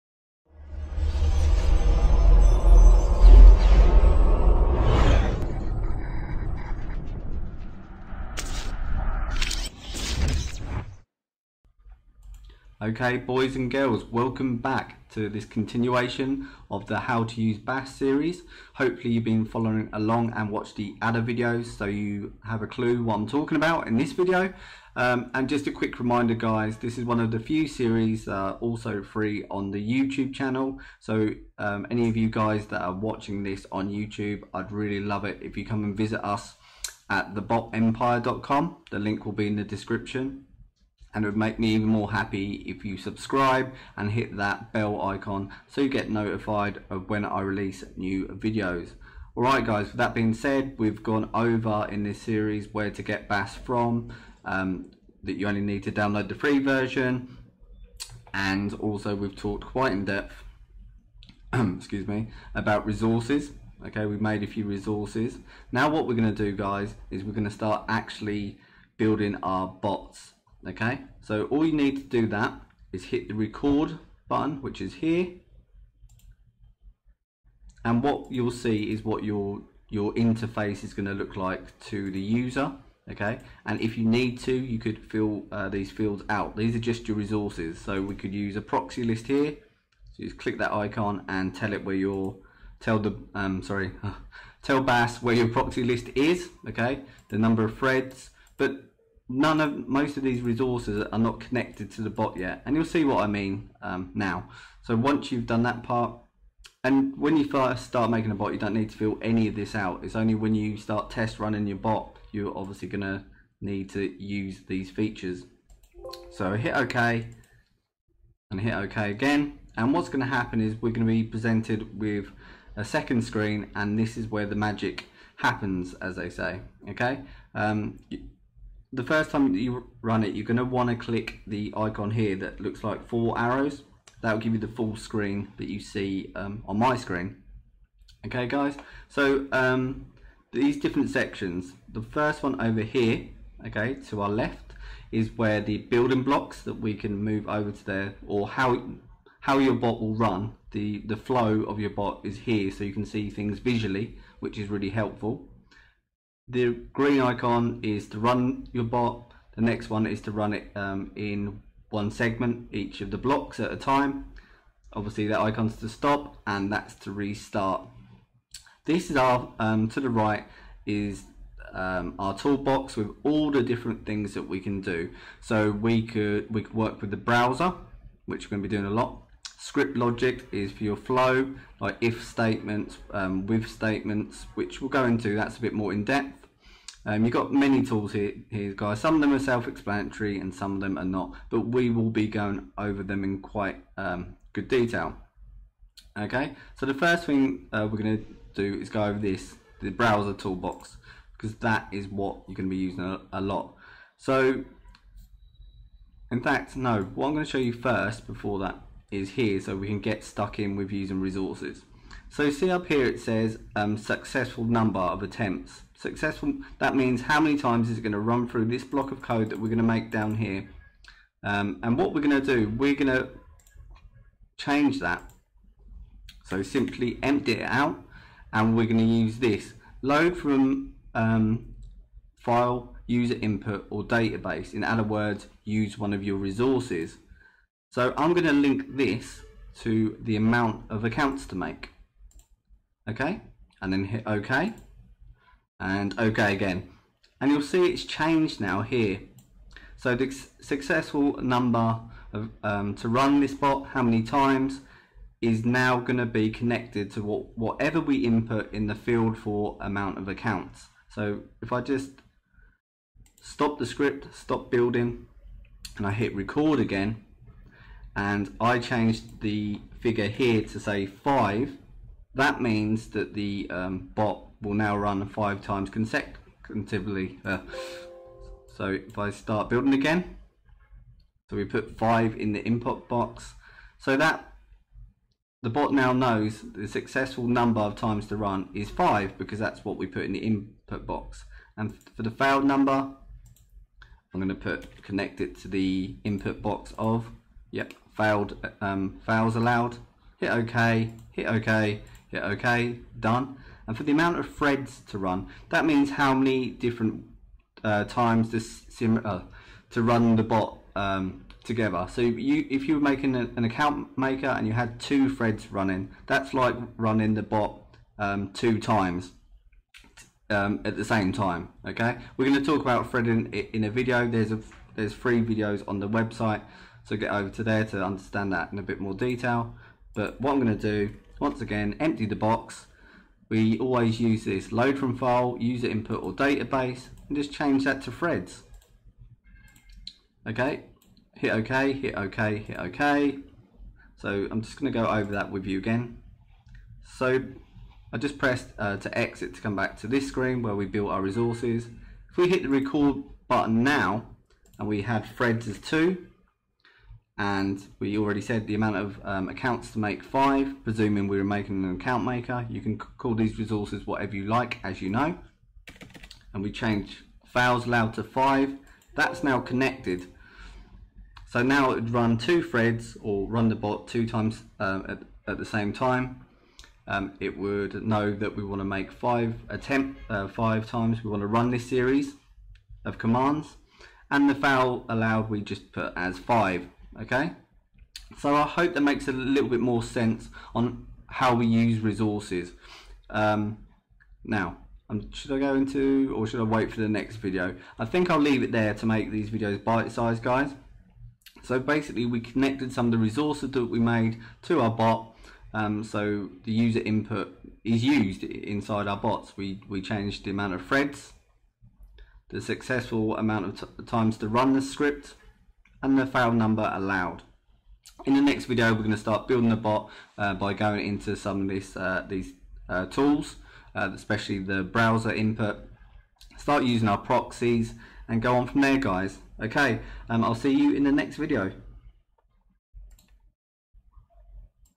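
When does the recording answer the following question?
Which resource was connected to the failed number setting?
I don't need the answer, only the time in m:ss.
4:59.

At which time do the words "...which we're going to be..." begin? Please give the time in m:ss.
2:58.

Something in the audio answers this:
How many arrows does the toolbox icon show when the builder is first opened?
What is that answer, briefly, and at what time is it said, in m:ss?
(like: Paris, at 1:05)
4, at 2:13.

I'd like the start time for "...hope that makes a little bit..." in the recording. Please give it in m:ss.
6:28.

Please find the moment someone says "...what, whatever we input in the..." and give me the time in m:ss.
4:17.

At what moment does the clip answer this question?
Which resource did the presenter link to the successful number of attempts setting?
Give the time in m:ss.
4:00.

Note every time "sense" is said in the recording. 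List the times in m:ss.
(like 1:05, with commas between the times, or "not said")
6:30.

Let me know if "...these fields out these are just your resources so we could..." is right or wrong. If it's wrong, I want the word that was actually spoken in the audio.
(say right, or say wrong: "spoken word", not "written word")
right.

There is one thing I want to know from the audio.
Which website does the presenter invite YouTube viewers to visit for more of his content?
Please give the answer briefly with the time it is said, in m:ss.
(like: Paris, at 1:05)
thebotempire.com, at 0:37.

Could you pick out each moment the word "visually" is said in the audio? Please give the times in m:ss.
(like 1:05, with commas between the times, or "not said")
2:33.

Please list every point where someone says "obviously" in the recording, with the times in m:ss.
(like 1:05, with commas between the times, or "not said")
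1:52, 2:44.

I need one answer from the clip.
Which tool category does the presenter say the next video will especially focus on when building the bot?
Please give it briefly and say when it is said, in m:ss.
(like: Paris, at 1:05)
browser input, at 7:04.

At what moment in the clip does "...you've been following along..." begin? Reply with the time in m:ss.
0:19.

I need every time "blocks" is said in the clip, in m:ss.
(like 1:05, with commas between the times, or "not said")
2:26, 2:43, 3:38.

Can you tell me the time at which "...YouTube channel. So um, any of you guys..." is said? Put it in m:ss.
0:29.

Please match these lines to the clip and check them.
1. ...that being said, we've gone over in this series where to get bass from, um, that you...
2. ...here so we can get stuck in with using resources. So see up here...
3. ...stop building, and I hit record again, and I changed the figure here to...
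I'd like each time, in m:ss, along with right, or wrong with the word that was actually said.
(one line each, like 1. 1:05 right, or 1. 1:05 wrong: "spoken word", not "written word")
1. 0:49 right
2. 3:29 right
3. 4:24 right.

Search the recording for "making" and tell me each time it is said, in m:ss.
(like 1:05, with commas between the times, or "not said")
1:48, 5:13, 6:01.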